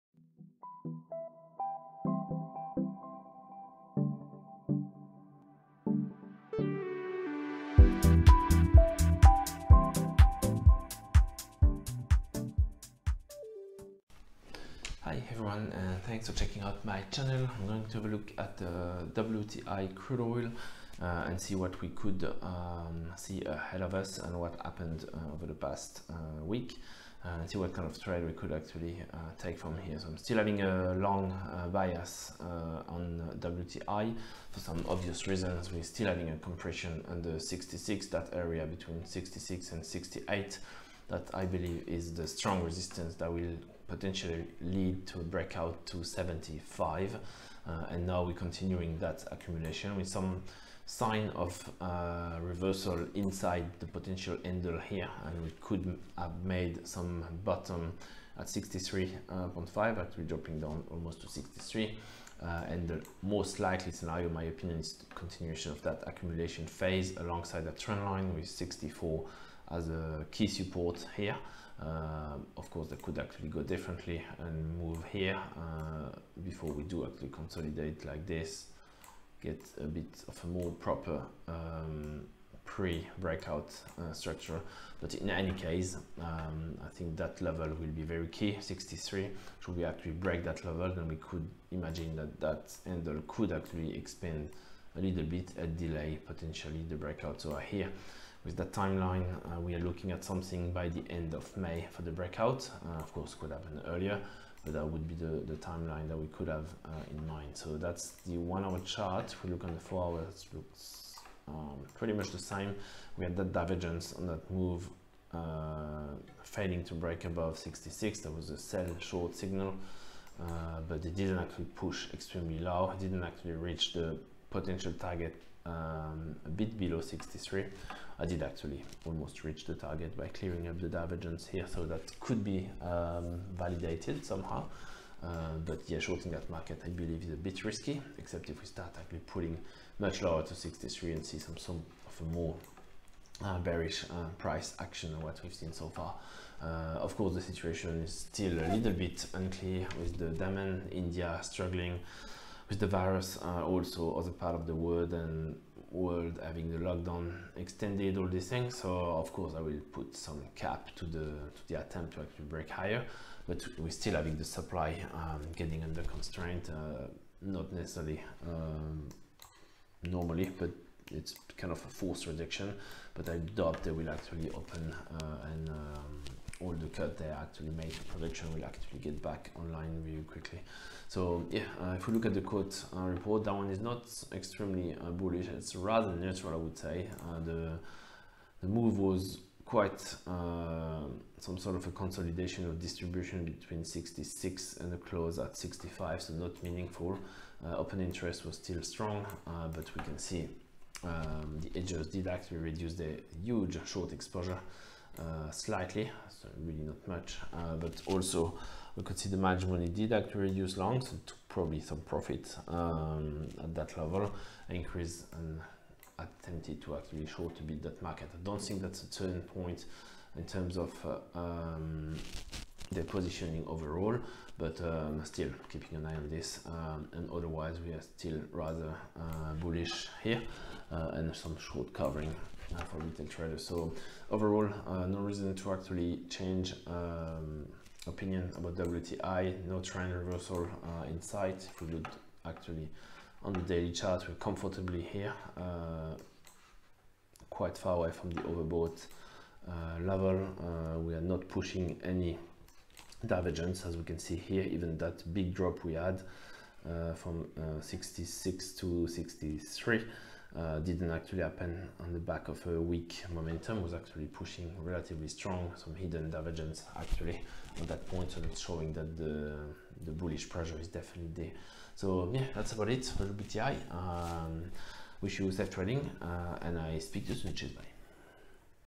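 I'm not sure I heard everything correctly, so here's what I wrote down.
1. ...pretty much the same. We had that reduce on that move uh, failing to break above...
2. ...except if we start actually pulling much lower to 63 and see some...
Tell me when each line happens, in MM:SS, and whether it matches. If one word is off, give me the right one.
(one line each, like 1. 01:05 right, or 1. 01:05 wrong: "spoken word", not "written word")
1. 01:51 wrong: "divergence", not "reduce"
2. 02:18 right.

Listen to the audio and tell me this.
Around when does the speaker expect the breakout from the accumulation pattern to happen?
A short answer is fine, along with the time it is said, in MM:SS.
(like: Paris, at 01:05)
End of May, at 01:41.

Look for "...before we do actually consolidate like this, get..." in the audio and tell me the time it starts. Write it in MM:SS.
01:16.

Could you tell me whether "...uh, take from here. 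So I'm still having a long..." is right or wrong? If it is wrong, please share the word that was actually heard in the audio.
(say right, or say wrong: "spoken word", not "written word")
right.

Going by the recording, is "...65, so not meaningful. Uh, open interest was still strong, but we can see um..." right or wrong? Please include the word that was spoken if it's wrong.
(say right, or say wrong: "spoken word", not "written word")
right.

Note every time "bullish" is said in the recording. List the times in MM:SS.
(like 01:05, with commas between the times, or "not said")
03:05, 03:49, 04:30.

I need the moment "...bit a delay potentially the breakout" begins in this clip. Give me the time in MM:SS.
01:35.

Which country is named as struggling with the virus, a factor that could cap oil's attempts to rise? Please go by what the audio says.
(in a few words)
India.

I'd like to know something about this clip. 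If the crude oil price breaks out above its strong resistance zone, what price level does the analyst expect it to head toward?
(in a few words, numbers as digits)
75.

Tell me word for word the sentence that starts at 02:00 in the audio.
Uh, but it didn't actually push extremely low.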